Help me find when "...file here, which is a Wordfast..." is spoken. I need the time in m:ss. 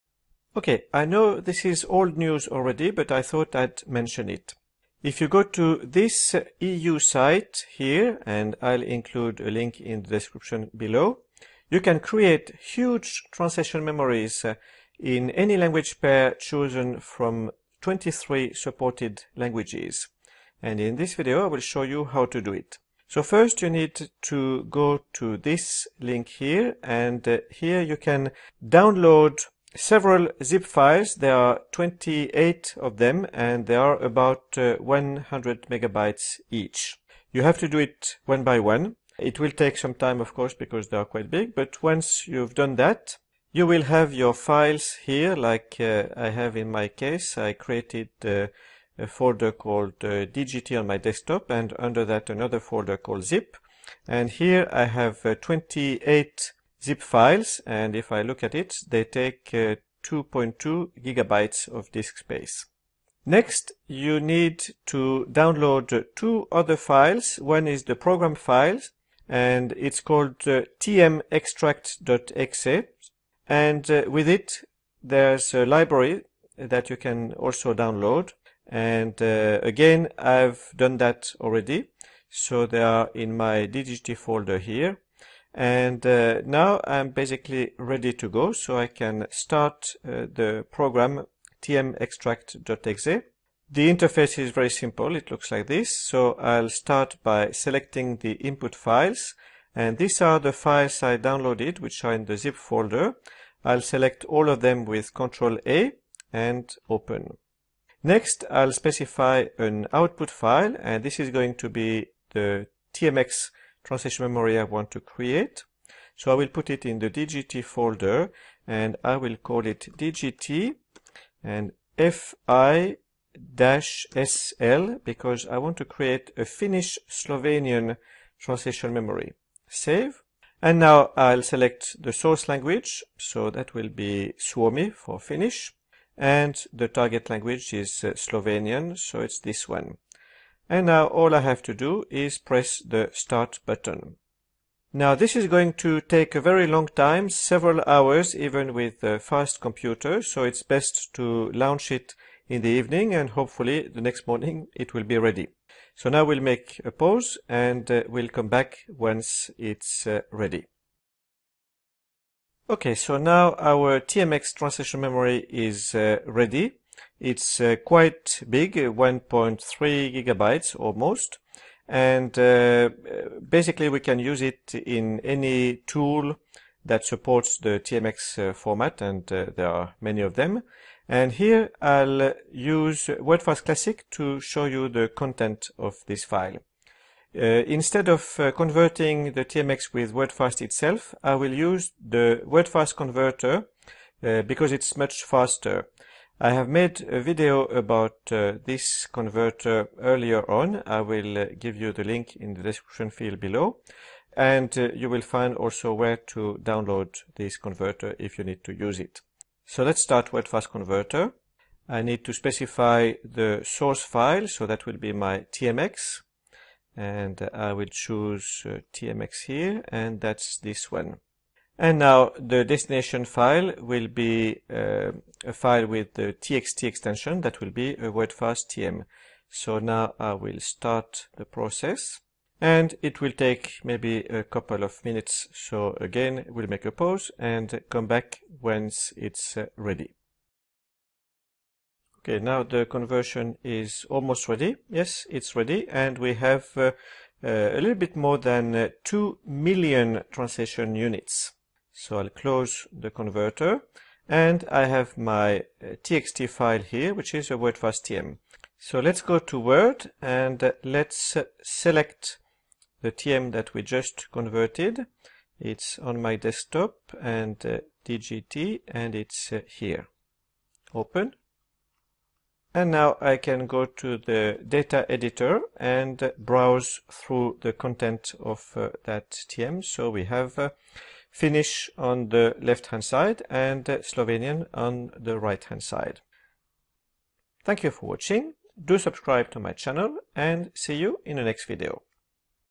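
4:16.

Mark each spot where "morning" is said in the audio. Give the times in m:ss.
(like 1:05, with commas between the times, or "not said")
2:34.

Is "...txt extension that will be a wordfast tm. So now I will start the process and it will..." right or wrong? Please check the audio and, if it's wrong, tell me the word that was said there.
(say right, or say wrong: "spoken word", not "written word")
right.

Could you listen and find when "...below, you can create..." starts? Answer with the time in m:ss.
0:10.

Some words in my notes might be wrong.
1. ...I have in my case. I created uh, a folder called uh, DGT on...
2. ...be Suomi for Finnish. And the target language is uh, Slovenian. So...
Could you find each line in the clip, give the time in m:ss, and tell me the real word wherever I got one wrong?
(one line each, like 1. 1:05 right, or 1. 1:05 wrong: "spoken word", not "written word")
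1. 0:46 right
2. 2:13 right.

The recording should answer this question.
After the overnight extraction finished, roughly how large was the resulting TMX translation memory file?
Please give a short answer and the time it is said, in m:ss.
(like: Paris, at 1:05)
1.3 gigabytes, at 2:48.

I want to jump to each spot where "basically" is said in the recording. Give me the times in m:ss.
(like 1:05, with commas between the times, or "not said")
1:27, 2:53.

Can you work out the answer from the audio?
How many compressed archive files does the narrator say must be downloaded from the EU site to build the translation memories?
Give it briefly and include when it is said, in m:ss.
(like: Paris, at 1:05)
28, at 0:31.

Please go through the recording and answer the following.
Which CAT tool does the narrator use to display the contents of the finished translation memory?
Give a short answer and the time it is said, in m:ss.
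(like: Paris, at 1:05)
Wordfast Classic, at 3:03.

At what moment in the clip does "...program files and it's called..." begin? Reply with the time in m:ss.
1:07.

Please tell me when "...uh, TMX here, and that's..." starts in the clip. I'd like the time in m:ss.
3:38.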